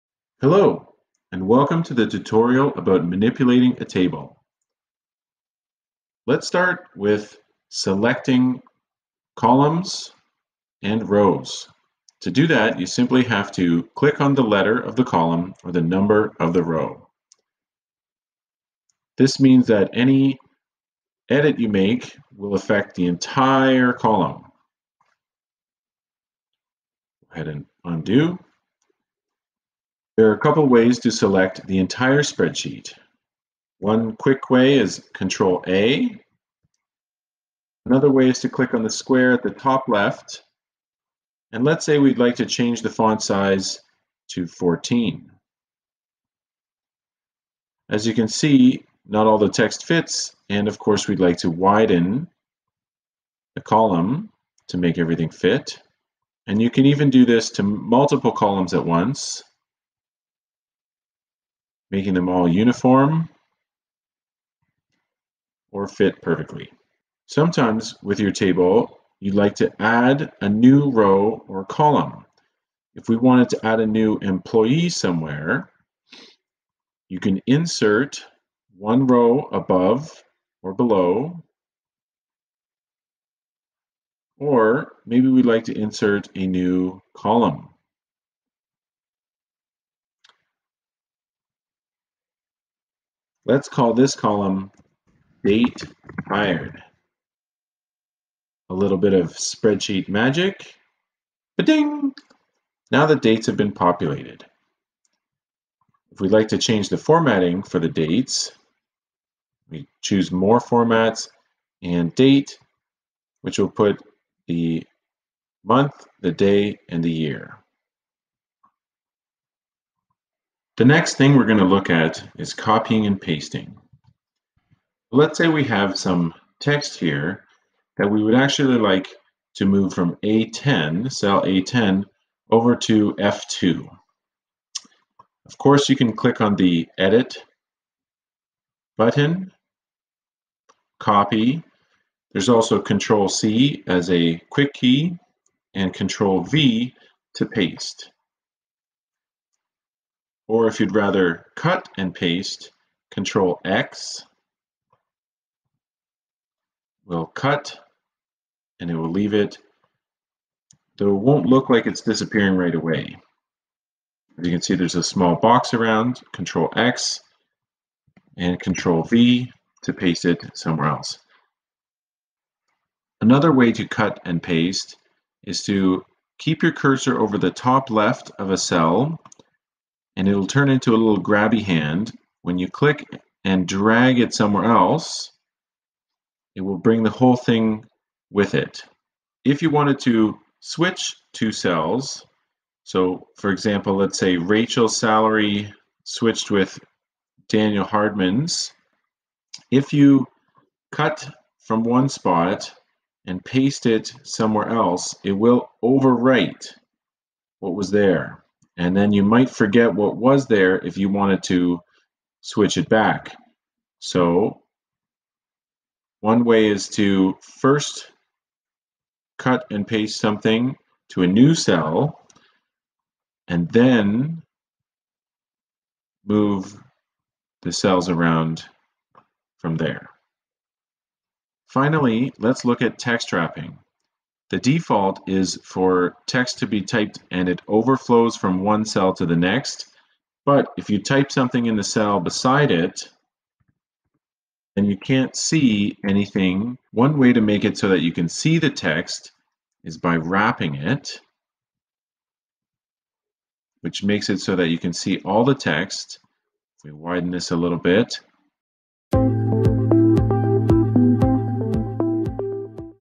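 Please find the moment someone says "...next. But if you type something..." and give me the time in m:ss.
3:59.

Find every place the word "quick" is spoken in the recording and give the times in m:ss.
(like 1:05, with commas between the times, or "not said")
0:34, 2:24.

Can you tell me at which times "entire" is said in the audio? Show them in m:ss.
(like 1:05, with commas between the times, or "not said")
0:23, 0:31.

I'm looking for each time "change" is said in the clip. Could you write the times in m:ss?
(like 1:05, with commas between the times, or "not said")
0:42, 1:46.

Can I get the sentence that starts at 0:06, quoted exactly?
Let's start with selecting columns and rows.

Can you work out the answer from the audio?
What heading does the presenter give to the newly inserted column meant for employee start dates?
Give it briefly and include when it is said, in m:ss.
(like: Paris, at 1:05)
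Date hired, at 1:35.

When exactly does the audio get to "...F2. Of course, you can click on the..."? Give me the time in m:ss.
2:13.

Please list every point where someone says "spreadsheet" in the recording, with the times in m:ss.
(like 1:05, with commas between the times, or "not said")
0:32, 1:39.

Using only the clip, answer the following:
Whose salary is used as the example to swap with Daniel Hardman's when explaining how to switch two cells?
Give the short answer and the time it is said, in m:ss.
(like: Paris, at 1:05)
Rachel, at 3:14.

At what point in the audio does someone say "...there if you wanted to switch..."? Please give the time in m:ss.
3:30.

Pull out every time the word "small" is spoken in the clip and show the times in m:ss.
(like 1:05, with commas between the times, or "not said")
2:45.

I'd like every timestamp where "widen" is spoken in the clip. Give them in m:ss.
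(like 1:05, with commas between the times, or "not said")
0:51, 4:16.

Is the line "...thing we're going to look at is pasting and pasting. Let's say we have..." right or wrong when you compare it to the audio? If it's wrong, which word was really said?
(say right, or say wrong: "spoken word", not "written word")
wrong: "copying", not "pasting".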